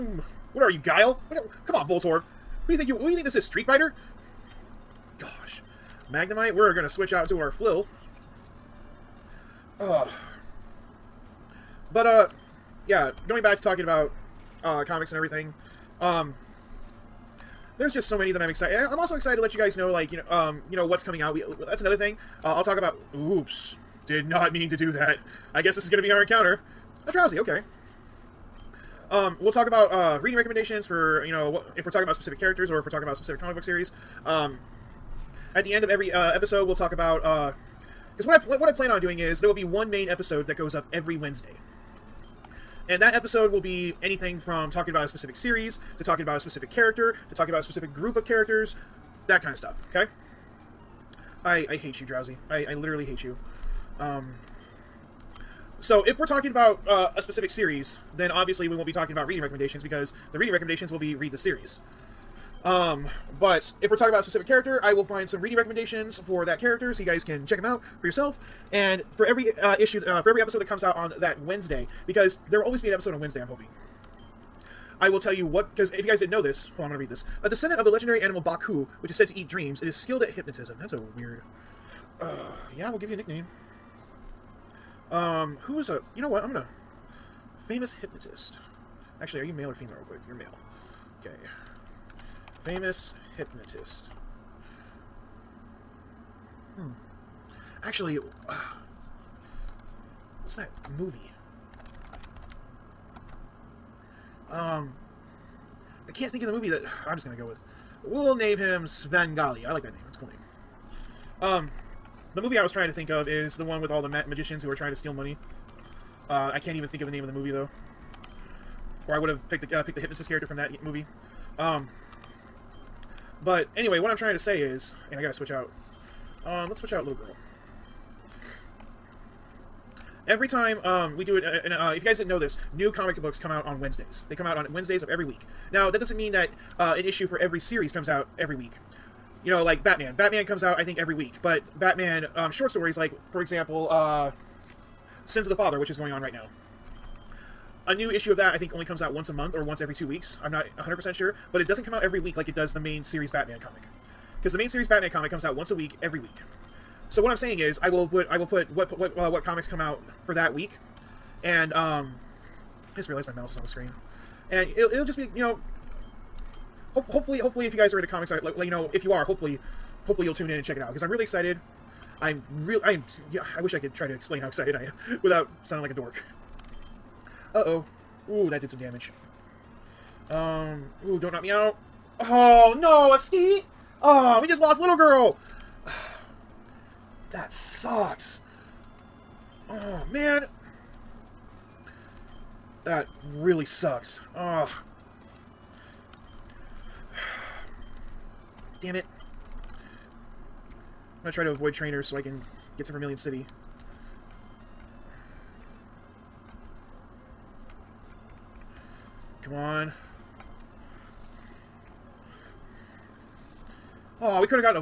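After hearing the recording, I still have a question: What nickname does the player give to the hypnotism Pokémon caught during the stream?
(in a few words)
Svengali.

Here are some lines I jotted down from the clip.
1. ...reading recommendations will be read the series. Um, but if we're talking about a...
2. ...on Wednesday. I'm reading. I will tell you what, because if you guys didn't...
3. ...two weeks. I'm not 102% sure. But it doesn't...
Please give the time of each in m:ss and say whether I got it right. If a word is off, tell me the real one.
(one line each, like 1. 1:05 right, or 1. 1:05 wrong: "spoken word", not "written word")
1. 1:00 right
2. 1:13 wrong: "hoping", not "reading"
3. 2:29 wrong: "100", not "102".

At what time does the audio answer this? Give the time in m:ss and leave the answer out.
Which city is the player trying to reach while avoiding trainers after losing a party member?
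3:22.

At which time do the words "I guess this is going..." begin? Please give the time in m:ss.
0:25.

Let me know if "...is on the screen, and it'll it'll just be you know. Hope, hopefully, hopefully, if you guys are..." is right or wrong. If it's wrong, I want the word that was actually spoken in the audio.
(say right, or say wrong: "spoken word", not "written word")
right.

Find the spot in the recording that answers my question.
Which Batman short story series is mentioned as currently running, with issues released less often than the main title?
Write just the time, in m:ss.
2:25.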